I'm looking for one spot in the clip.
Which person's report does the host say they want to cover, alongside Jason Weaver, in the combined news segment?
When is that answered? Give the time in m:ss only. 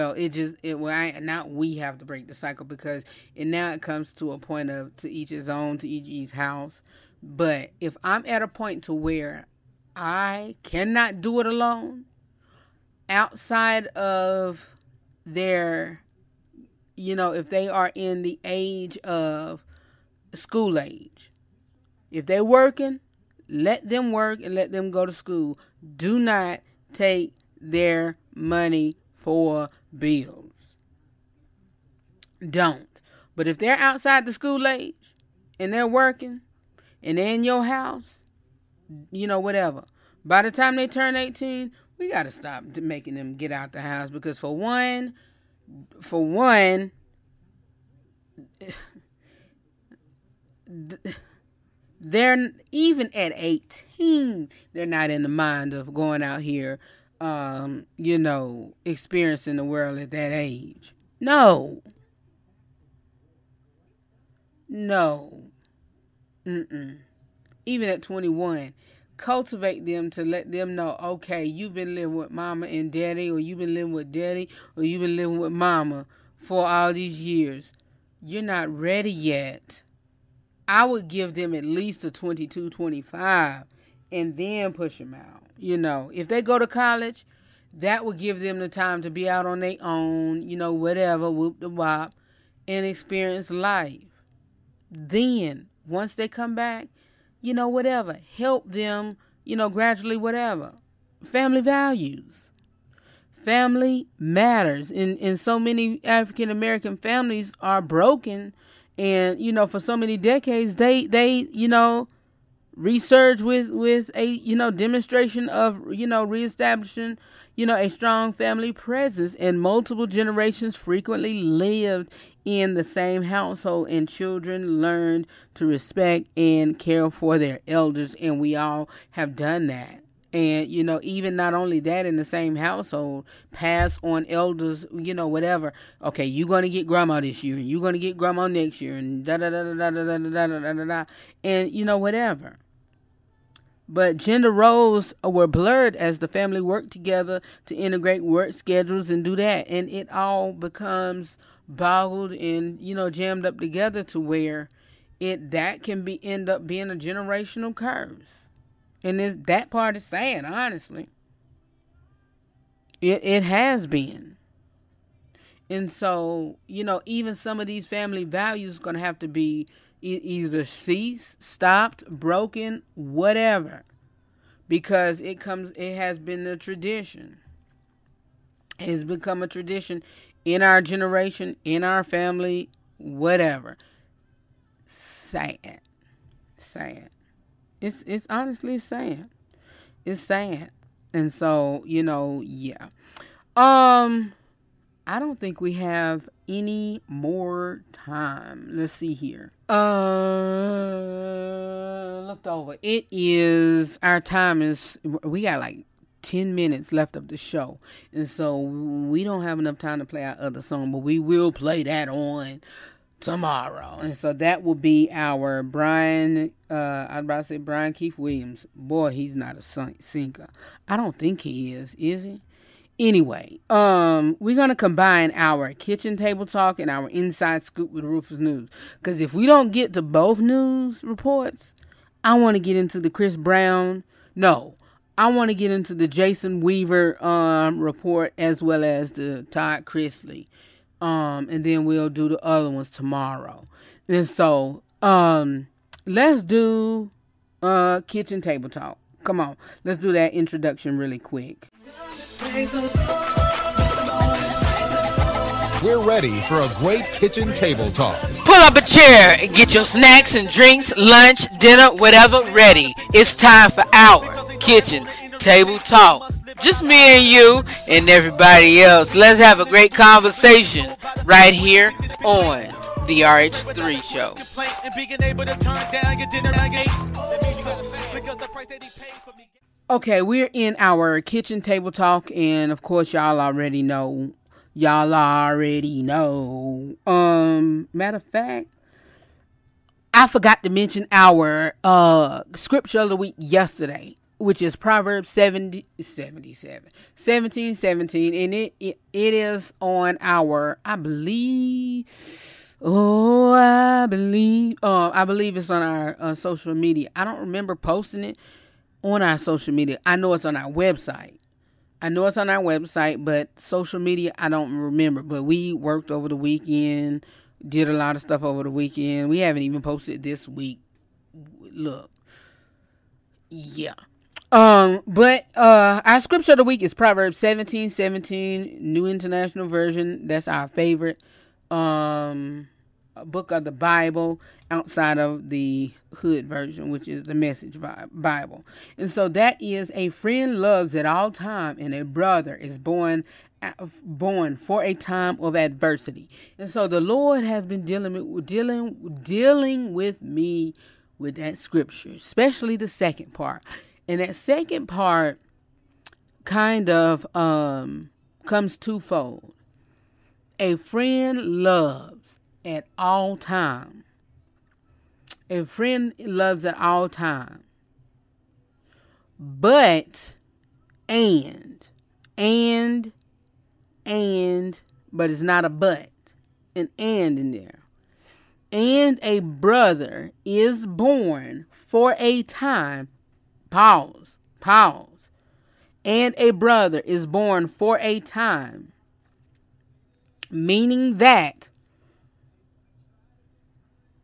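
3:59.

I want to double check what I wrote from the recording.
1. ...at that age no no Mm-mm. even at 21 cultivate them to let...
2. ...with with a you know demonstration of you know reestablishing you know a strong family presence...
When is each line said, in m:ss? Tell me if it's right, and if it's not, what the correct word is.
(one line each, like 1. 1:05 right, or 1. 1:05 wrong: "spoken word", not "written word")
1. 0:59 right
2. 1:53 right.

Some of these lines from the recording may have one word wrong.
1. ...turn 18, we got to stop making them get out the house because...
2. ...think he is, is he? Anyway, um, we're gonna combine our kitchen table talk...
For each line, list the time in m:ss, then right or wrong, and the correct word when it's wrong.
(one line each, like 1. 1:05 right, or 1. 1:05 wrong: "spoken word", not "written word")
1. 0:40 right
2. 3:41 right.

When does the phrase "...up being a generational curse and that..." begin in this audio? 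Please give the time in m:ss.
2:36.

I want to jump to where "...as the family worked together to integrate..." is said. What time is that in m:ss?
2:25.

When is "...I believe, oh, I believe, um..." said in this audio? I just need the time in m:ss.
5:00.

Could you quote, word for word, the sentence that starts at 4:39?
Okay, we're in our kitchen table talk, and of course, y'all already know.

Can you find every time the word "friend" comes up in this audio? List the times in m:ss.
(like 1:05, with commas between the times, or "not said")
5:40, 6:00, 6:05.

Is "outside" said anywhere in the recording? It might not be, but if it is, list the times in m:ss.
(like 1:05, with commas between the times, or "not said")
0:13, 0:33, 5:34.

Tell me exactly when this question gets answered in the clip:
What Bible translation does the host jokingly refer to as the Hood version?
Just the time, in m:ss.
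5:37.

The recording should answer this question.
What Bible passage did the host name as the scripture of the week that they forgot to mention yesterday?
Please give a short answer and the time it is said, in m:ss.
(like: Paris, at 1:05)
Proverbs 17:17, at 5:26.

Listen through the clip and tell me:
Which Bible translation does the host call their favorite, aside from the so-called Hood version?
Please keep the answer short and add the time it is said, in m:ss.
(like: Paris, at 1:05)
New International Version, at 5:28.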